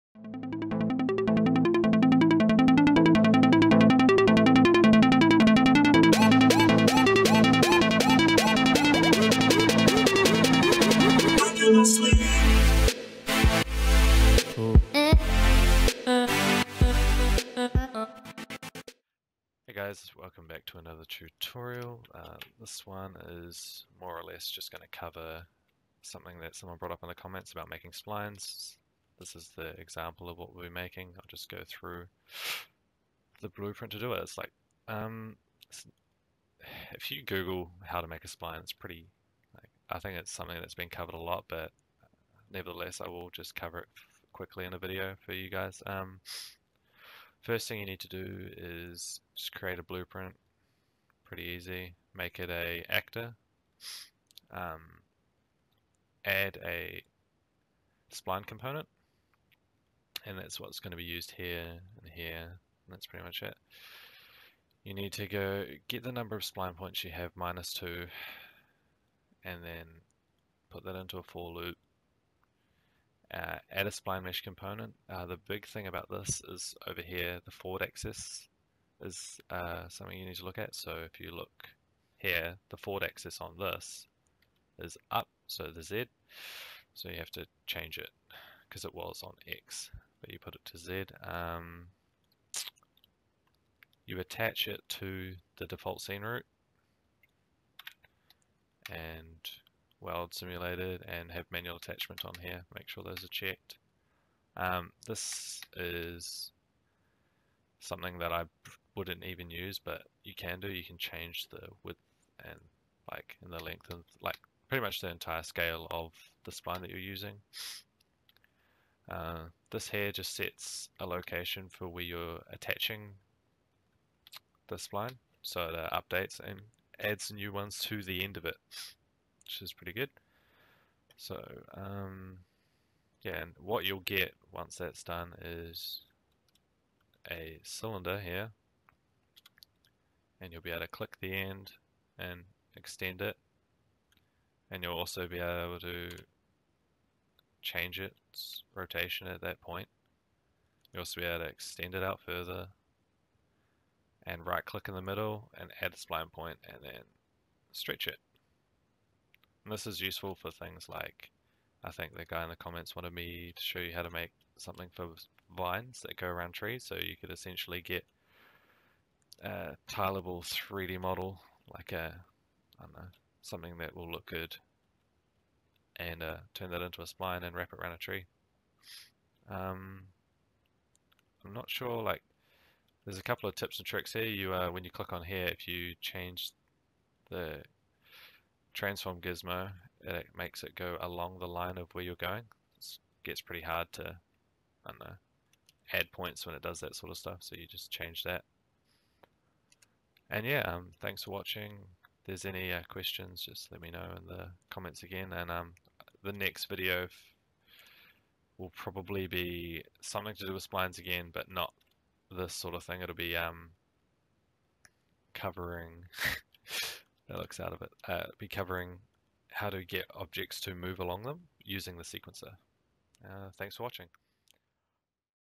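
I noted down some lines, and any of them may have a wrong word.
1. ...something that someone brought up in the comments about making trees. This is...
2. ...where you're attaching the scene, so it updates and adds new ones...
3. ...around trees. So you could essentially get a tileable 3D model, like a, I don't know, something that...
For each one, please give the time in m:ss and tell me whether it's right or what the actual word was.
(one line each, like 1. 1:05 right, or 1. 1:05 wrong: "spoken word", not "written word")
1. 0:26 wrong: "splines", not "trees"
2. 2:01 wrong: "spline", not "scene"
3. 2:46 right.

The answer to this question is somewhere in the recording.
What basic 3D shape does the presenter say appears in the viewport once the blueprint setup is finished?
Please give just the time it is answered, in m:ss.
2:17.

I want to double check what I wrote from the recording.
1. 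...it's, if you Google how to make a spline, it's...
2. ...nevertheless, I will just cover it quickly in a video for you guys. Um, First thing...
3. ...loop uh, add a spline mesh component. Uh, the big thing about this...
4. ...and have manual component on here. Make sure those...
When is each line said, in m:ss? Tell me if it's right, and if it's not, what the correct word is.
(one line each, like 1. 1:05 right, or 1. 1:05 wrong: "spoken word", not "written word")
1. 0:35 right
2. 0:42 right
3. 1:11 right
4. 1:41 wrong: "attachment", not "component".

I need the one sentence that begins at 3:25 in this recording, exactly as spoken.
And um, the next video will probably be something to do with splines again, but not this sort of thing.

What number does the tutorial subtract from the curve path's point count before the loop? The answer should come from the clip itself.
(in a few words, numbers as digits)
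2.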